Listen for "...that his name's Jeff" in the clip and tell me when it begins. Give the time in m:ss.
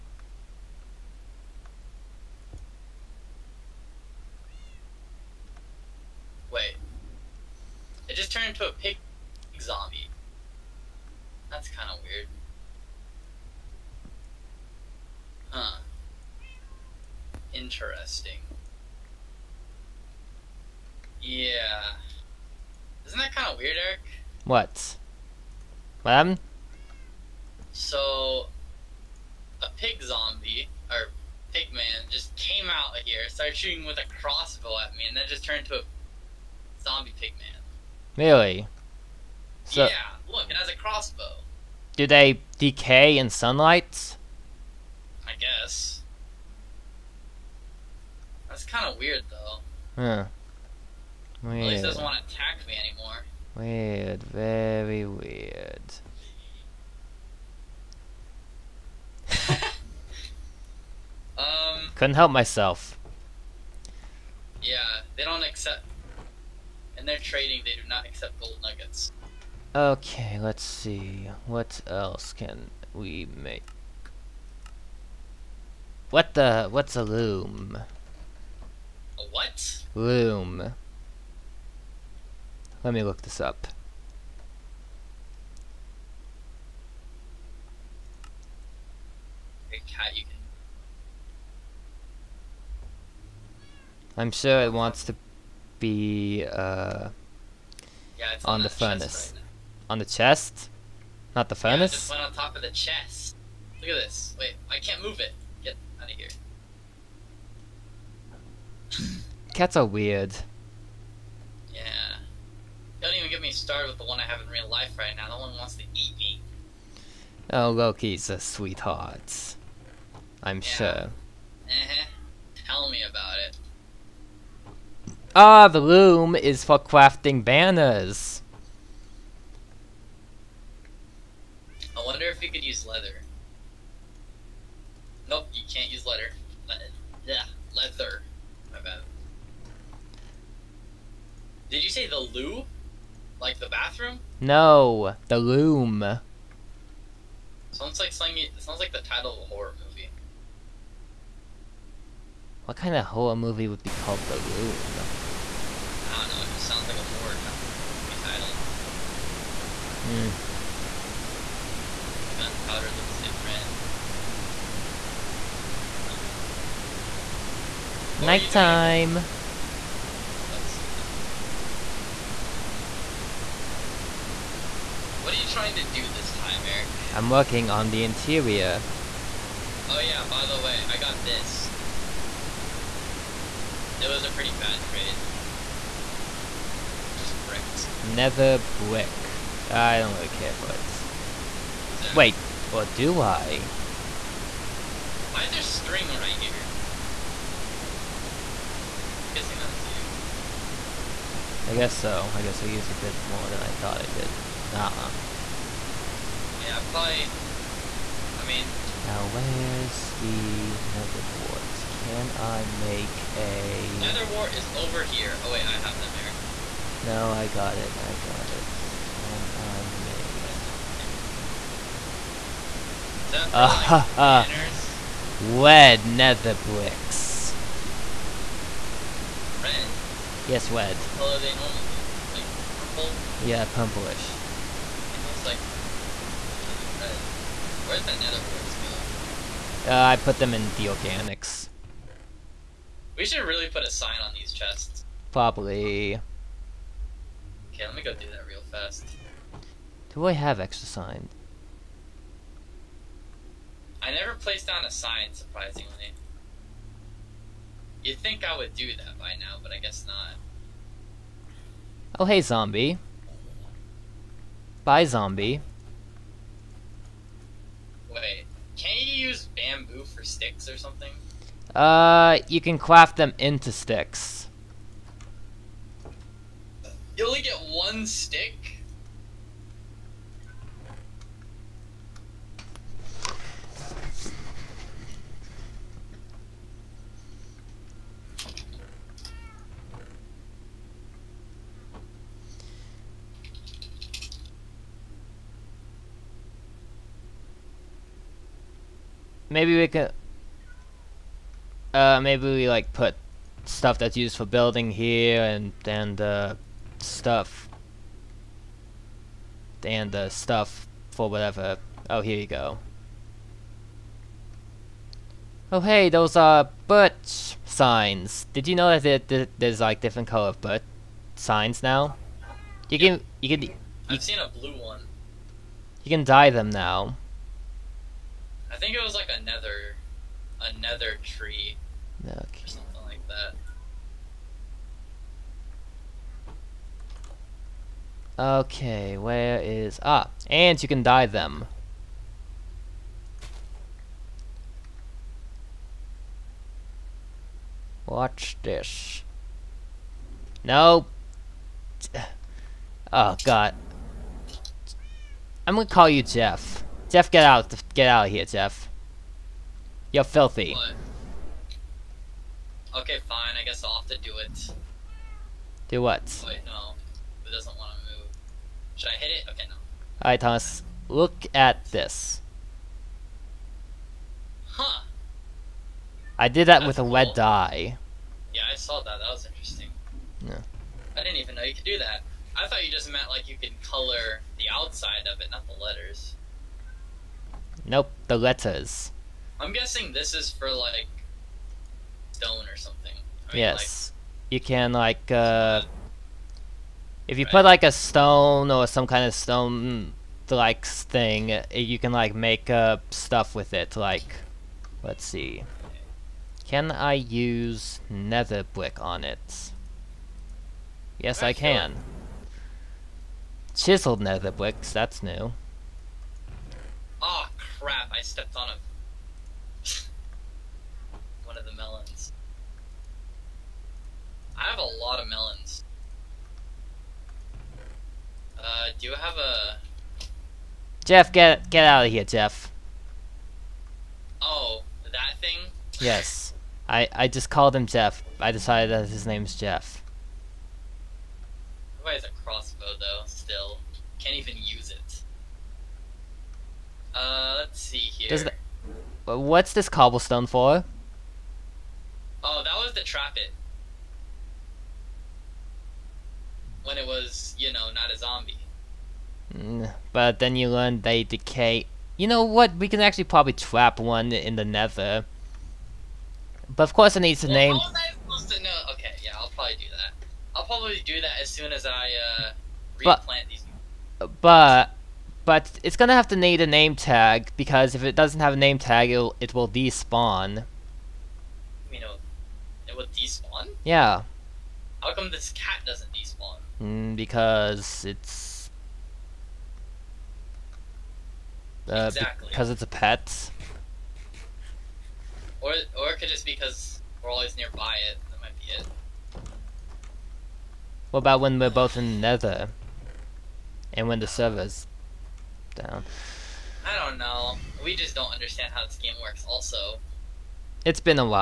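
7:18.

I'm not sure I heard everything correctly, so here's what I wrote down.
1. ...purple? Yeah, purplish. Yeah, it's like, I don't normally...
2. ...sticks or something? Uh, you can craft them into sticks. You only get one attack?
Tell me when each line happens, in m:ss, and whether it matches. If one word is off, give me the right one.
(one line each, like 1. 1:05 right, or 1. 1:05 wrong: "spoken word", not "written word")
1. 3:52 wrong: "usually", not "normally"
2. 4:30 wrong: "stick", not "attack".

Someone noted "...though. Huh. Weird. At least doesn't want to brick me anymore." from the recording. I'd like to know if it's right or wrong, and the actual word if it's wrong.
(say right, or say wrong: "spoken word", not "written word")
wrong: "attack", not "brick".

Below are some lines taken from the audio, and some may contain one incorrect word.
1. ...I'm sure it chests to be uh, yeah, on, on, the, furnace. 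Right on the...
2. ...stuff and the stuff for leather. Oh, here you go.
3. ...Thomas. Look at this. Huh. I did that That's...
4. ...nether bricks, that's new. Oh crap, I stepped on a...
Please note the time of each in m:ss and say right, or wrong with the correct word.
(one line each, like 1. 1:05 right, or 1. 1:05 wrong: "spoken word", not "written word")
1. 1:34 wrong: "wants", not "chests"
2. 5:07 wrong: "whatever", not "leather"
3. 6:10 right
4. 6:54 right.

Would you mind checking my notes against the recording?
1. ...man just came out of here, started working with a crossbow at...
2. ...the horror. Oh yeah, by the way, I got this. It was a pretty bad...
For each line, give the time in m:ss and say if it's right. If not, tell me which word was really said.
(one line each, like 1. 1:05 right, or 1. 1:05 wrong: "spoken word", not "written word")
1. 0:31 wrong: "shooting", not "working"
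2. 2:57 wrong: "interior", not "horror".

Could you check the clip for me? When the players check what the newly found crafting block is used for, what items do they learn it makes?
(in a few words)
banners.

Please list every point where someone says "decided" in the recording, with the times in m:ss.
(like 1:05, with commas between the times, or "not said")
7:18.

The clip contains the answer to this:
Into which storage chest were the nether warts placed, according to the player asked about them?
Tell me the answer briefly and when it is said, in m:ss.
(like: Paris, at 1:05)
organics, at 4:00.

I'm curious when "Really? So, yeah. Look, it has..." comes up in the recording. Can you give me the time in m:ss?
0:38.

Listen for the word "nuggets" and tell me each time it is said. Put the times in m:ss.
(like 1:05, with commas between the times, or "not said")
1:08.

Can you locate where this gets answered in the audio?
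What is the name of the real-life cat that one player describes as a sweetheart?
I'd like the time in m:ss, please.
1:57.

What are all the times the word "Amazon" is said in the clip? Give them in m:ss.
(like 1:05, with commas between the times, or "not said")
not said.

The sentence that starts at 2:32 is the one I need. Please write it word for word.
What kind of horror movie would be called The Loom?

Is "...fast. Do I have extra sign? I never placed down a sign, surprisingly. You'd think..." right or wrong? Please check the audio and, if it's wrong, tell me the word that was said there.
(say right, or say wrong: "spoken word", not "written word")
right.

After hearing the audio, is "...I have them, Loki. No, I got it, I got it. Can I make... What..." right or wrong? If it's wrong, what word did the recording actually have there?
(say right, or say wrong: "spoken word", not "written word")
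wrong: "Eric", not "Loki".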